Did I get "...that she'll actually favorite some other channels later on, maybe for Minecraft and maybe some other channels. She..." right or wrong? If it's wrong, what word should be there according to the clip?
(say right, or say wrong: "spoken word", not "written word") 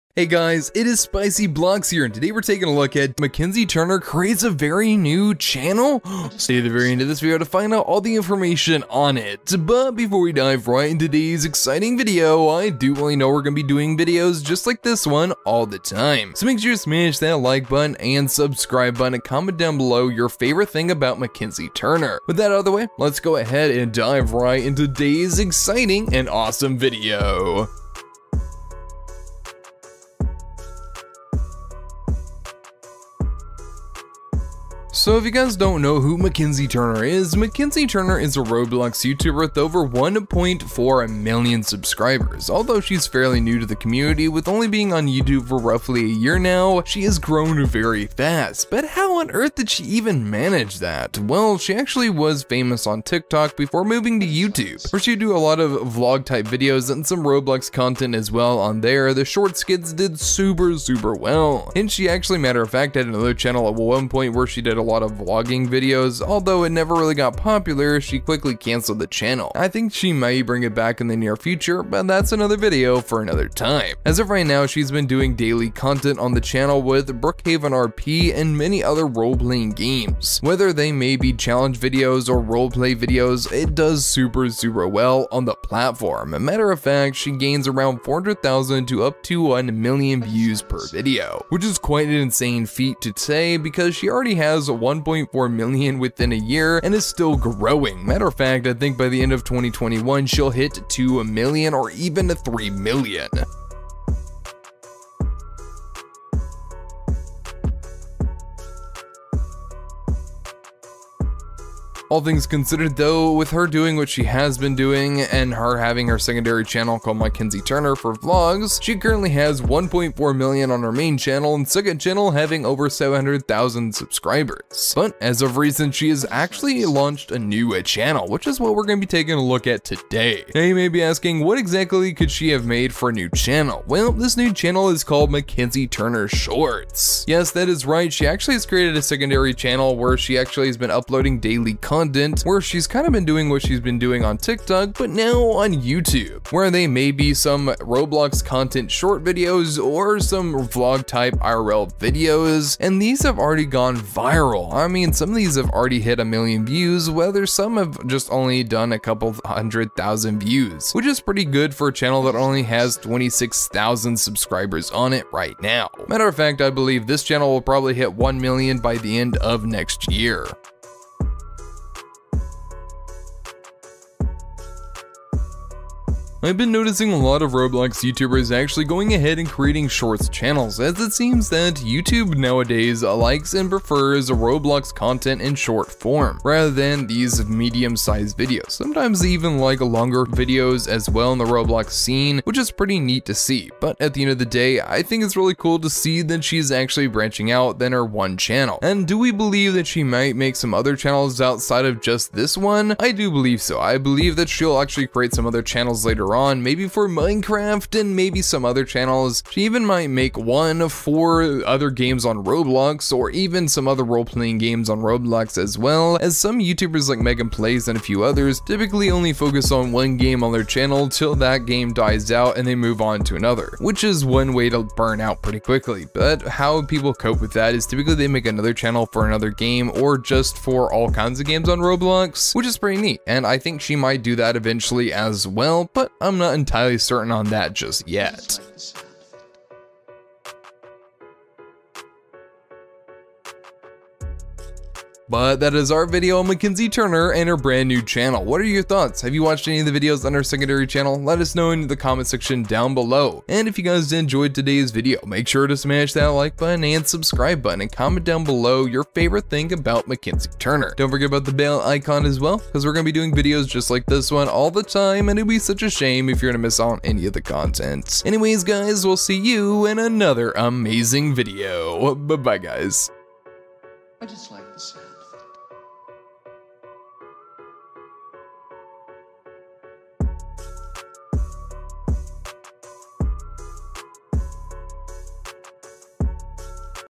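wrong: "create", not "favorite".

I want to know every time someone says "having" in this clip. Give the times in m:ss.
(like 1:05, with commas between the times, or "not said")
1:55, 2:02.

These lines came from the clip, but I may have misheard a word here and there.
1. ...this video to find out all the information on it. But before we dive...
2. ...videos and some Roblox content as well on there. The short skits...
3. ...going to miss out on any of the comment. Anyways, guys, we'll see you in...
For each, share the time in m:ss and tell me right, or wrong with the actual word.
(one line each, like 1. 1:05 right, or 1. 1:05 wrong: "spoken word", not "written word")
1. 0:07 right
2. 0:56 right
3. 4:26 wrong: "content", not "comment".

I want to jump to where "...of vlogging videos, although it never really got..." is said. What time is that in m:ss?
1:05.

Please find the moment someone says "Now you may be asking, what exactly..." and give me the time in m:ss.
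2:10.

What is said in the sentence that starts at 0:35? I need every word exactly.
So if you guys don't know who Mackenzie Turner is, Mackenzie Turner is a Roblox YouTuber with over 1.4 million subscribers.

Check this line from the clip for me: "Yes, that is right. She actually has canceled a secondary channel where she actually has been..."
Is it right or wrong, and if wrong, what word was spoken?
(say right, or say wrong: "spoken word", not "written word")
wrong: "created", not "canceled".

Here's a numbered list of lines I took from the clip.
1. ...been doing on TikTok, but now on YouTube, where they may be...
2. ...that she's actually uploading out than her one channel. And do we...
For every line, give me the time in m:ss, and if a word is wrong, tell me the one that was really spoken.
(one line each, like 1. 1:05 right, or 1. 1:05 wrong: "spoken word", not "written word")
1. 2:23 right
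2. 3:16 wrong: "branching", not "uploading".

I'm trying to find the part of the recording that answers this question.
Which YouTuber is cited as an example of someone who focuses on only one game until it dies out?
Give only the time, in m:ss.
3:37.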